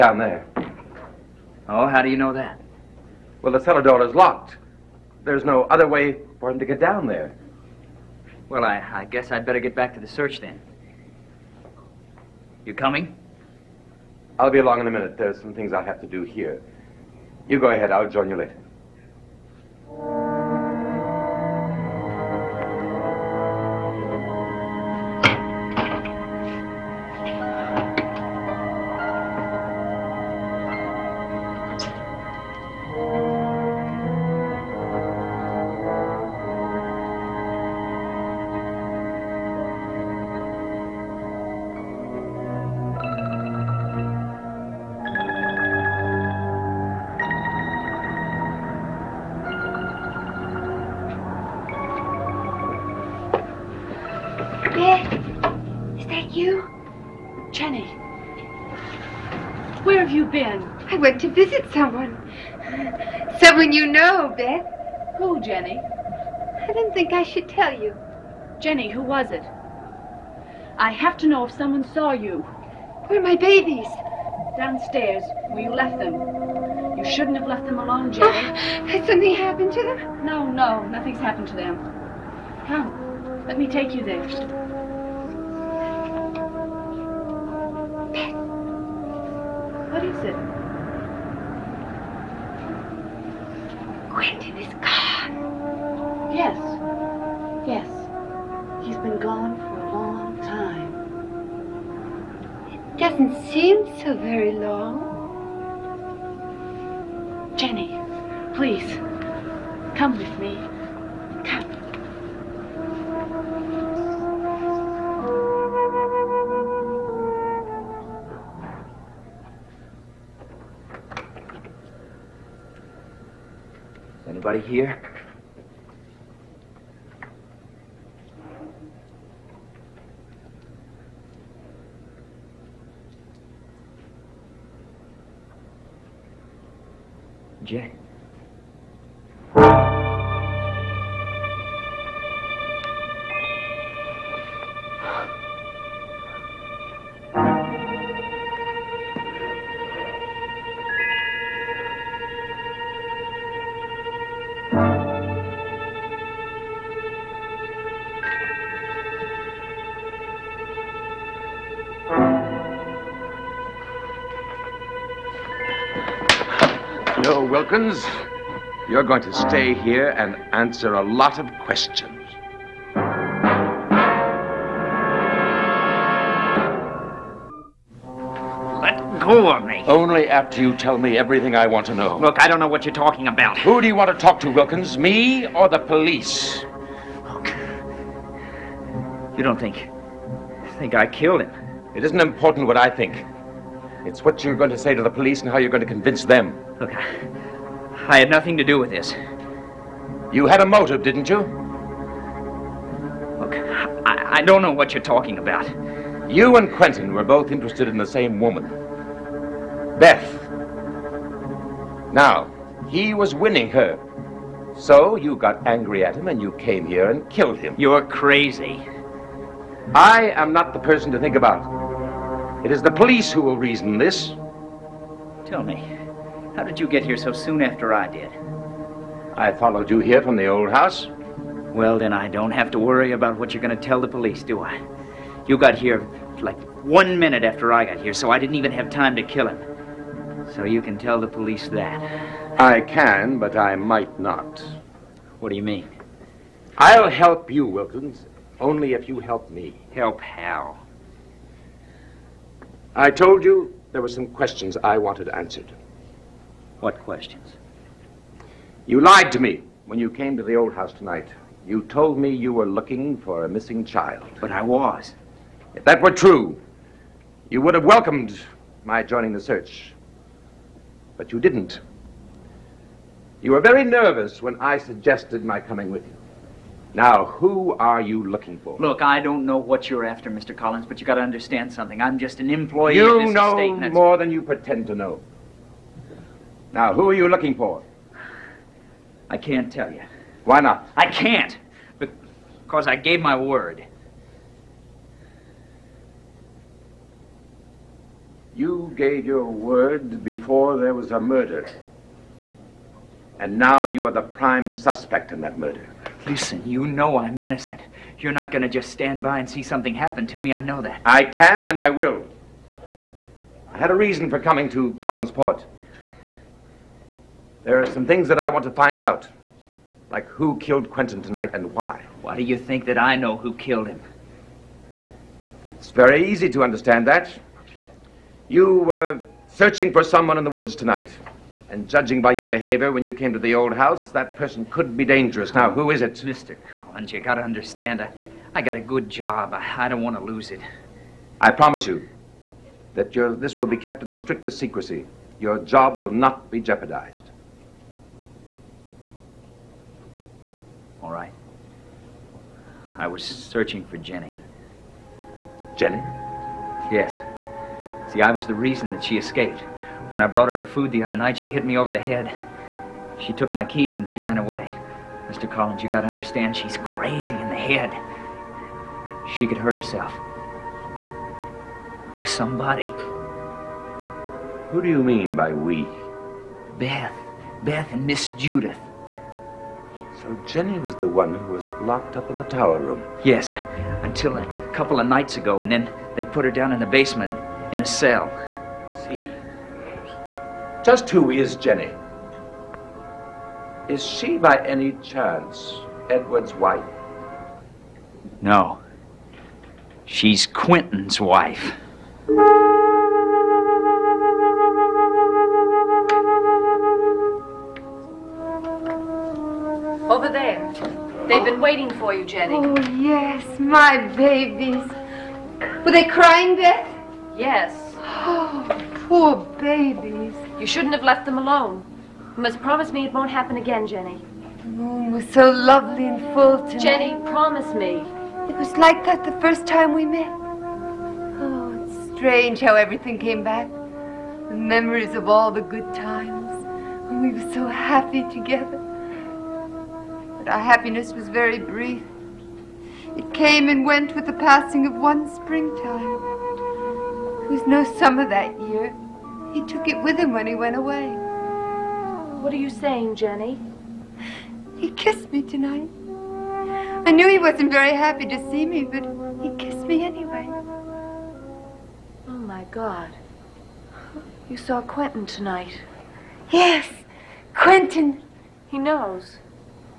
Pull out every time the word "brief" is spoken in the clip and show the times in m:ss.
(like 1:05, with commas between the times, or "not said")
7:21.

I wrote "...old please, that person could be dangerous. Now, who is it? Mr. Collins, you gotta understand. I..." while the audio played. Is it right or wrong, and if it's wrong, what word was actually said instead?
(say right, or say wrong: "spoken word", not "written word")
wrong: "house", not "please".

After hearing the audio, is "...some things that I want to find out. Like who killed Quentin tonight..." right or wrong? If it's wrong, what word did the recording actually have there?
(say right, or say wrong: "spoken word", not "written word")
right.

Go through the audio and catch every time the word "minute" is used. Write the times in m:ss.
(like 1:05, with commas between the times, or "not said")
0:14, 3:57.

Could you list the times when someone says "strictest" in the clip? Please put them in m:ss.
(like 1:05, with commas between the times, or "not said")
5:44.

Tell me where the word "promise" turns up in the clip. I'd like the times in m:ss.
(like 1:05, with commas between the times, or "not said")
5:41, 7:02, 7:07.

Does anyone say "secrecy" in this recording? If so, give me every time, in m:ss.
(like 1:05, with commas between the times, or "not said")
5:44.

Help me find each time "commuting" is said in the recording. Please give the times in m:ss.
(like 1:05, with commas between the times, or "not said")
not said.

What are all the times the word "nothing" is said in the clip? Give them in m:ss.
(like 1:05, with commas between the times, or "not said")
1:20, 3:18.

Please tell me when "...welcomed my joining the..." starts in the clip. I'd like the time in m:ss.
4:27.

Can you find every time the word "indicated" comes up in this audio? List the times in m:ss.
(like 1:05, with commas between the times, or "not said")
not said.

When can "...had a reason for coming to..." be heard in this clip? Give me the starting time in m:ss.
5:13.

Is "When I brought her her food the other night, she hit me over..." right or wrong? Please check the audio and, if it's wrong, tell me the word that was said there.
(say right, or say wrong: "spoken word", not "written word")
right.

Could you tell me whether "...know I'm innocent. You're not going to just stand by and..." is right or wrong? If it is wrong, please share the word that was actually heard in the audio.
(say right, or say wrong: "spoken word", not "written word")
right.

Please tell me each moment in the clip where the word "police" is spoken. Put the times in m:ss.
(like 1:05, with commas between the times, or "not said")
3:05, 3:15, 3:42, 3:54, 4:01.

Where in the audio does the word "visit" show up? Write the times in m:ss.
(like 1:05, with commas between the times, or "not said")
1:01.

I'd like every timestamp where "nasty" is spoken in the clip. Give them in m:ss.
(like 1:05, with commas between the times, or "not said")
not said.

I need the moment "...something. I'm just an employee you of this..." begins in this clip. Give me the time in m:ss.
4:41.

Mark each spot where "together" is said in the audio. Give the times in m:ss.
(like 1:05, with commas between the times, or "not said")
7:18.